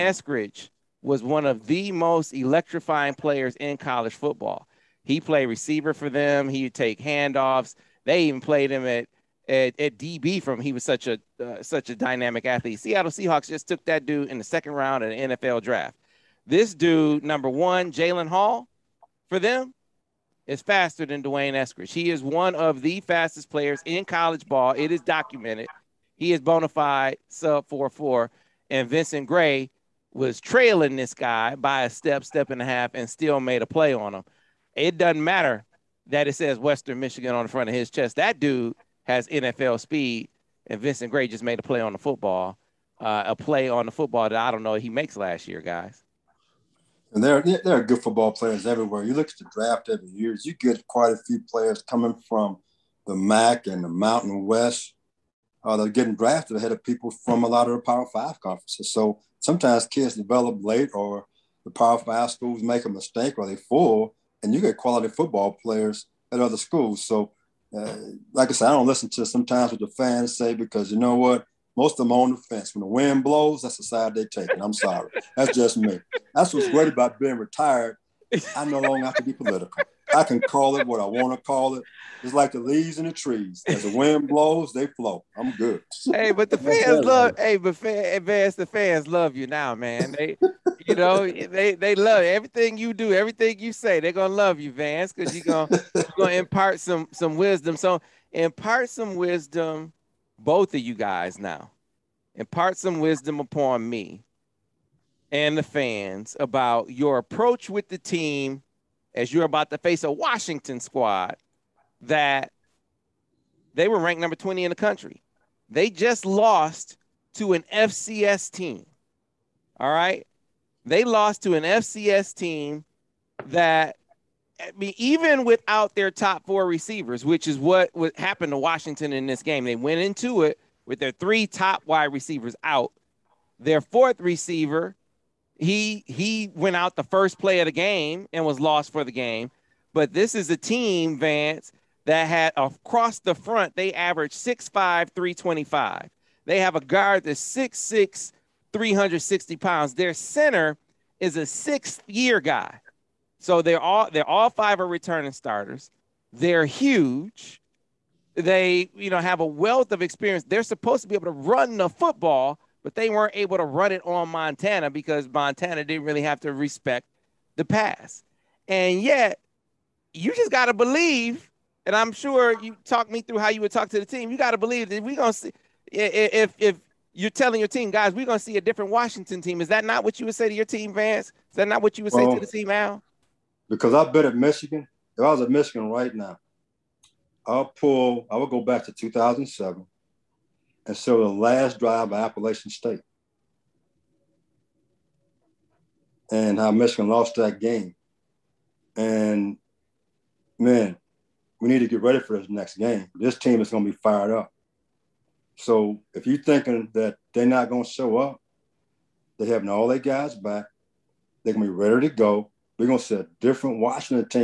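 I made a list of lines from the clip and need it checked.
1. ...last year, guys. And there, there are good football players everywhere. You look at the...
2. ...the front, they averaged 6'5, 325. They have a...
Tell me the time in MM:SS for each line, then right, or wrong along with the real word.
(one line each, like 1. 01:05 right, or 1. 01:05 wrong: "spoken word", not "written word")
1. 00:45 right
2. 02:23 right.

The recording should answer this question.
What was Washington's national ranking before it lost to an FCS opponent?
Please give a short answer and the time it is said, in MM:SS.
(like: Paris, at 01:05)
20, at 01:54.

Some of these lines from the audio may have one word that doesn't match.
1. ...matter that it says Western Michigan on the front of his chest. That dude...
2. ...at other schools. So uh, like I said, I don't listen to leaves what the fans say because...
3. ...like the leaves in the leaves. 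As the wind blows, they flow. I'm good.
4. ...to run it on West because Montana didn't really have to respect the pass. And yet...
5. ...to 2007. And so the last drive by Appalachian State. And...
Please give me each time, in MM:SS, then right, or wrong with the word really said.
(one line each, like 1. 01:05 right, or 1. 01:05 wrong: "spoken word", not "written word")
1. 00:35 right
2. 01:06 wrong: "sometimes", not "leaves"
3. 01:22 wrong: "trees", not "leaves"
4. 02:43 wrong: "Montana", not "West"
5. 03:08 right.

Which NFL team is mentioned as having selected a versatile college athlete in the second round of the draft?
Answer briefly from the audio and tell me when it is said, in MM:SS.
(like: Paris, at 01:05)
Seattle Seahawks, at 00:12.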